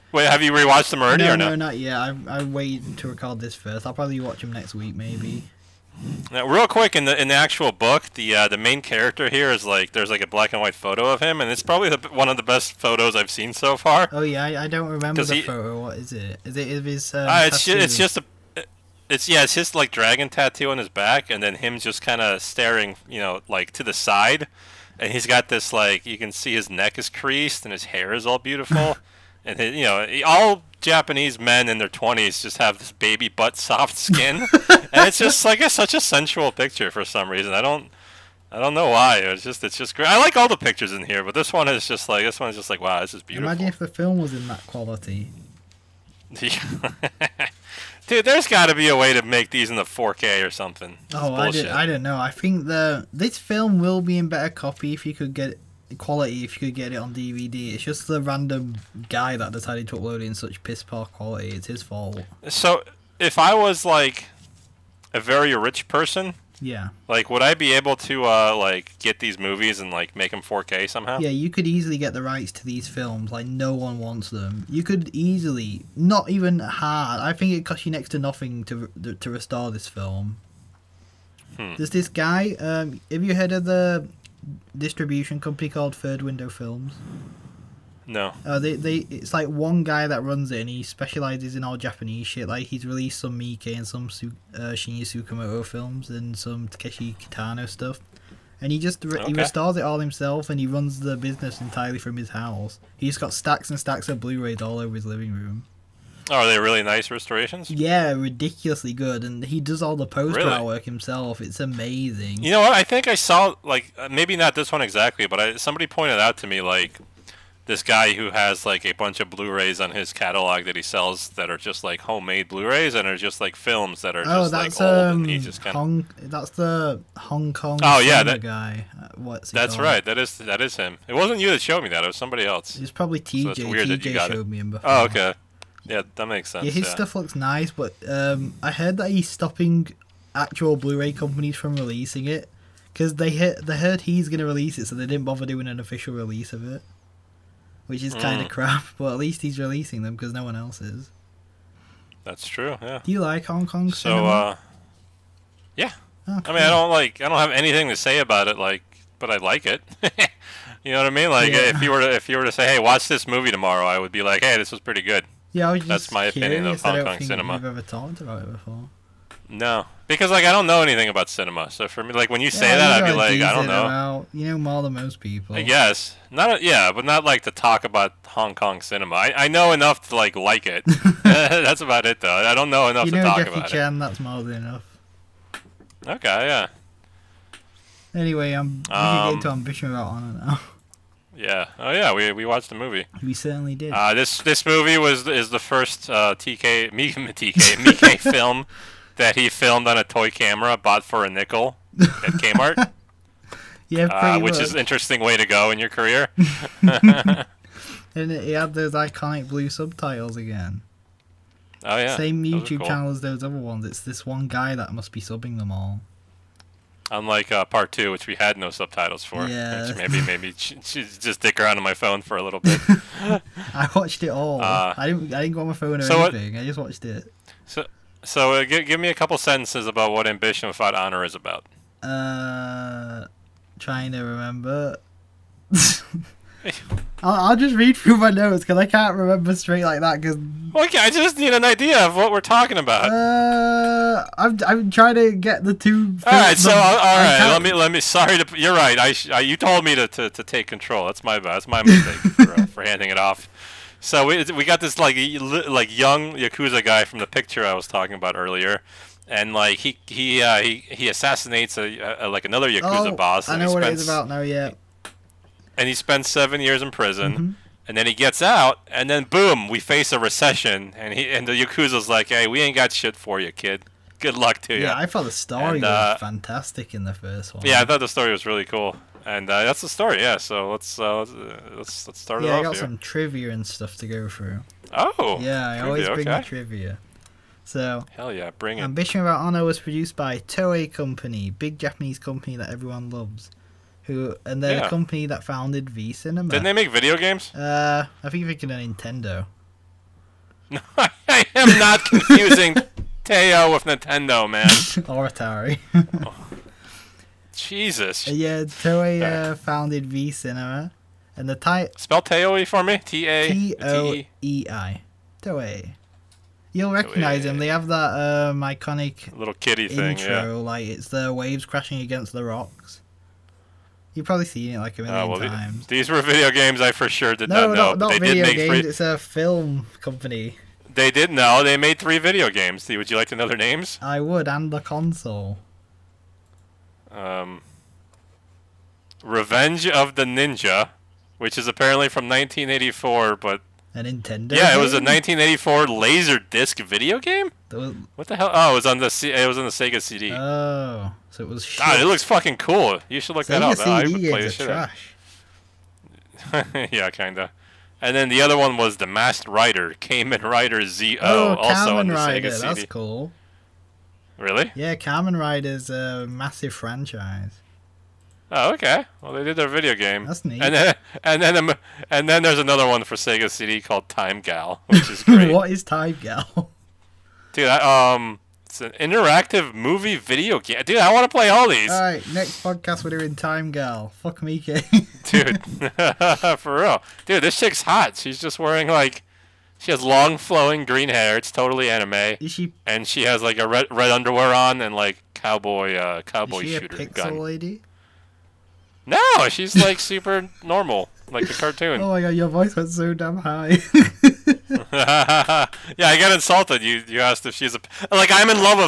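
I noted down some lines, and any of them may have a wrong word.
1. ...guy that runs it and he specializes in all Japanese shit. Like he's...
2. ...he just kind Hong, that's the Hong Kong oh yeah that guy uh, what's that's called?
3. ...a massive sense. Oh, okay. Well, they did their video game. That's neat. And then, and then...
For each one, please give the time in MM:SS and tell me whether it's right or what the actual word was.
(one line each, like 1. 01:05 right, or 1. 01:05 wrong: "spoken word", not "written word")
1. 01:29 right
2. 02:05 right
3. 06:05 wrong: "franchise", not "sense".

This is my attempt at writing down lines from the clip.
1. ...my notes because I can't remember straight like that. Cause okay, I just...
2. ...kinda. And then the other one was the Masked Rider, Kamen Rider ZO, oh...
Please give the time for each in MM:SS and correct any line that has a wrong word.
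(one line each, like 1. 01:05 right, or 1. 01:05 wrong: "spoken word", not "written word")
1. 03:58 right
2. 05:57 right.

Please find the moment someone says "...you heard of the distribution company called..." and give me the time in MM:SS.
01:23.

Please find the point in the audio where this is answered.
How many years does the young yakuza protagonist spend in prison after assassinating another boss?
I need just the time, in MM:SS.
04:26.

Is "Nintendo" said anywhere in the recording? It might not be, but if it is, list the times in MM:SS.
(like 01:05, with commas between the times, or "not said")
04:58, 05:03, 05:44.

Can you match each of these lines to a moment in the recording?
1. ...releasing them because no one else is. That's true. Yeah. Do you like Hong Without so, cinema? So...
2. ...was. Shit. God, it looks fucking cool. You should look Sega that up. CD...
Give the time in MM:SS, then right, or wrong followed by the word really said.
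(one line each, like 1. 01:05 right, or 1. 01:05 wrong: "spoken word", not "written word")
1. 02:29 wrong: "Kong", not "Without"
2. 05:51 right.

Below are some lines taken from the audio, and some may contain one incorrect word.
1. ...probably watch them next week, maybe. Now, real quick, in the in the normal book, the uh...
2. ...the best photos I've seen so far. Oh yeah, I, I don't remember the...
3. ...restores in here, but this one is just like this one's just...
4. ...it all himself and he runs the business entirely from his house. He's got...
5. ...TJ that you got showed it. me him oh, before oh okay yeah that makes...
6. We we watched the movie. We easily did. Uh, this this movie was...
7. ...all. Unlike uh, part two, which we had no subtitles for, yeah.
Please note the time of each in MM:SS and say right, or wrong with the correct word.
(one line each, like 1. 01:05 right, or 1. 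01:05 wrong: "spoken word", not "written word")
1. 00:03 wrong: "actual", not "normal"
2. 00:12 right
3. 00:40 wrong: "pictures", not "restores"
4. 01:39 right
5. 02:13 right
6. 03:12 wrong: "certainly", not "easily"
7. 03:35 right.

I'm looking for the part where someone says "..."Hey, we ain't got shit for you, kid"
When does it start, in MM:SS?
04:32.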